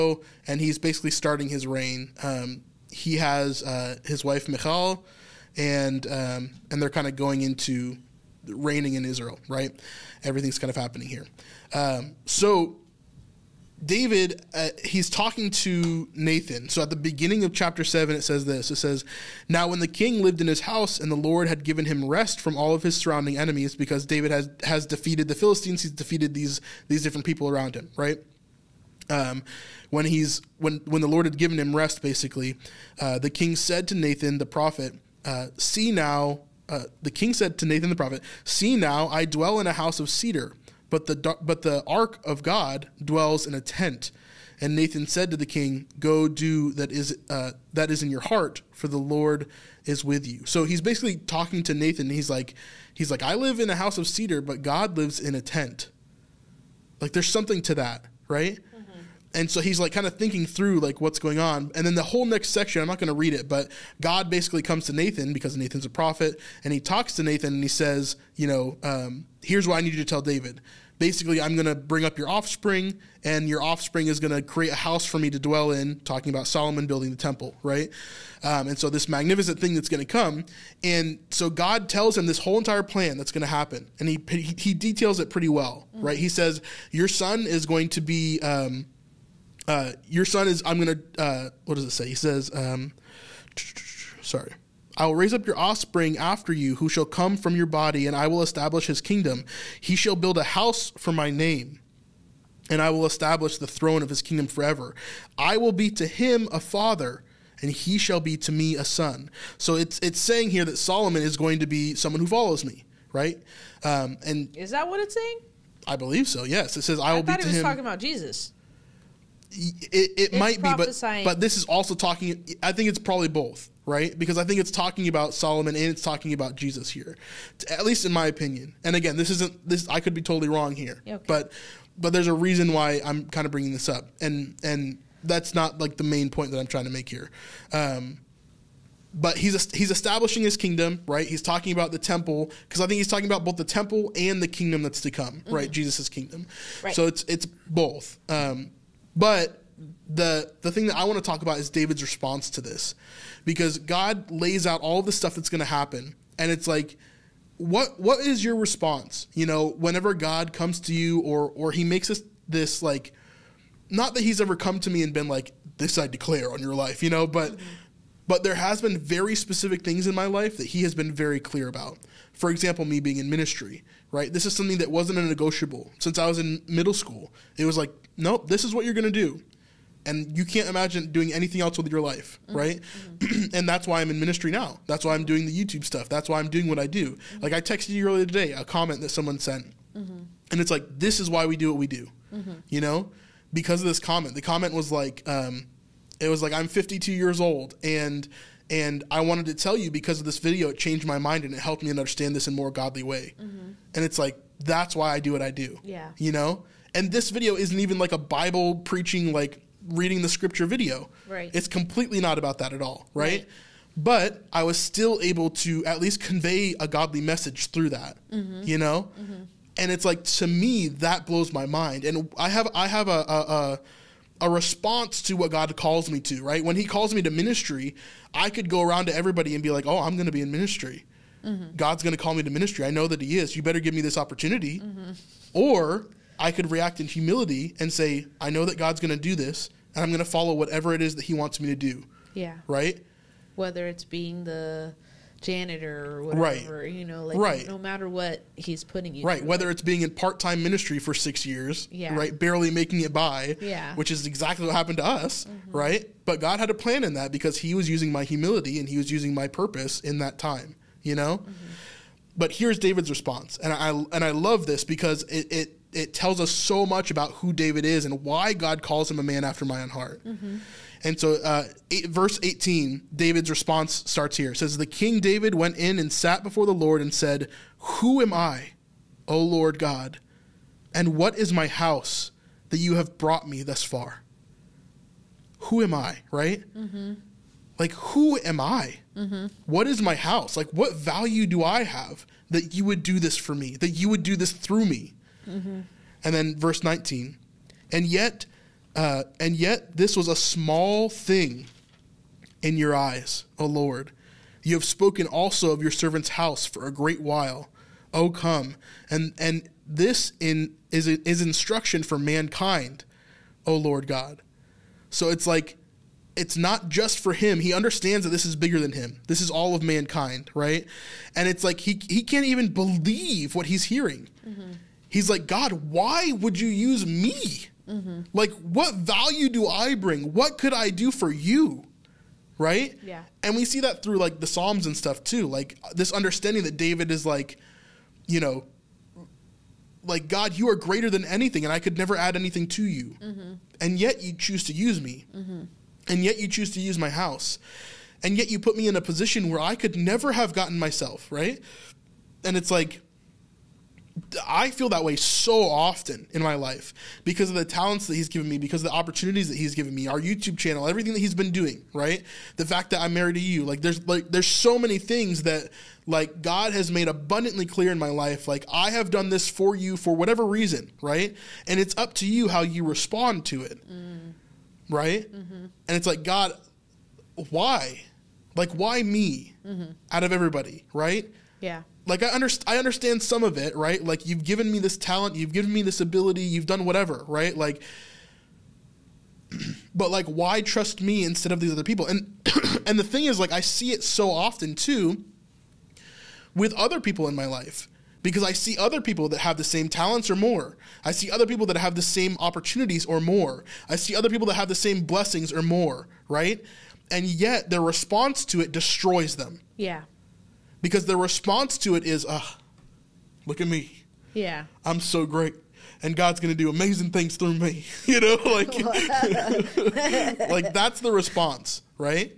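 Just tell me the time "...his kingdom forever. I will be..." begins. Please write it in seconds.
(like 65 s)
104 s.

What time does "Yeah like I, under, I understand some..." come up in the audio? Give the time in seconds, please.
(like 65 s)
381 s.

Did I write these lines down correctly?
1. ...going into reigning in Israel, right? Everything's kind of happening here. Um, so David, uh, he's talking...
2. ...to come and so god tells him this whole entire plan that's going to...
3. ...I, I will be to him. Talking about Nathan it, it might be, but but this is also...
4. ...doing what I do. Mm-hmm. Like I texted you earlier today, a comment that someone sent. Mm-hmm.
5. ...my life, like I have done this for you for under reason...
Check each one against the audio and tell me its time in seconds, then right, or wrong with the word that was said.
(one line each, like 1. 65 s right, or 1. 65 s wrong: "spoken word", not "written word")
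1. 7 s right
2. 80 s right
3. 116 s wrong: "Jesus", not "Nathan"
4. 186 s right
5. 367 s wrong: "whatever", not "under".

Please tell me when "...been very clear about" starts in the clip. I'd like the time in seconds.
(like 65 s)
170 s.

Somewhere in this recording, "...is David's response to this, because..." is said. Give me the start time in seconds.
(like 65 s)
151 s.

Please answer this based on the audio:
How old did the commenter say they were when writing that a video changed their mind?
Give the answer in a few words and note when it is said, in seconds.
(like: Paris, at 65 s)
52, at 196 s.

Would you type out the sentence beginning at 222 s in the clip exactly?
And I have, I have a, a, a a response to what God calls me to, right?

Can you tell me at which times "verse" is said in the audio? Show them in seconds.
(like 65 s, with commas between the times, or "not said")
272 s, 296 s.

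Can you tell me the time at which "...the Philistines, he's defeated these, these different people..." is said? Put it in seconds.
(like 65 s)
25 s.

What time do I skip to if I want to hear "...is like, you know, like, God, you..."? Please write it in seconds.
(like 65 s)
337 s.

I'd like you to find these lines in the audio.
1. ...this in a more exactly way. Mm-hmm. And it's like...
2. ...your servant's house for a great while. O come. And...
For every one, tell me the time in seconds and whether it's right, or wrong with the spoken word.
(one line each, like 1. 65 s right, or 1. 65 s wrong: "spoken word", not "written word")
1. 202 s wrong: "godly", not "exactly"
2. 305 s right.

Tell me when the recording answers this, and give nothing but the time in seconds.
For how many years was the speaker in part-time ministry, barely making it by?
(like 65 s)
251 s.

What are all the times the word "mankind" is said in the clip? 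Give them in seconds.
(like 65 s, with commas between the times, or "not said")
312 s, 319 s.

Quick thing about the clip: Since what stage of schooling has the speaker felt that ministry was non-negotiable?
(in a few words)
Middle school.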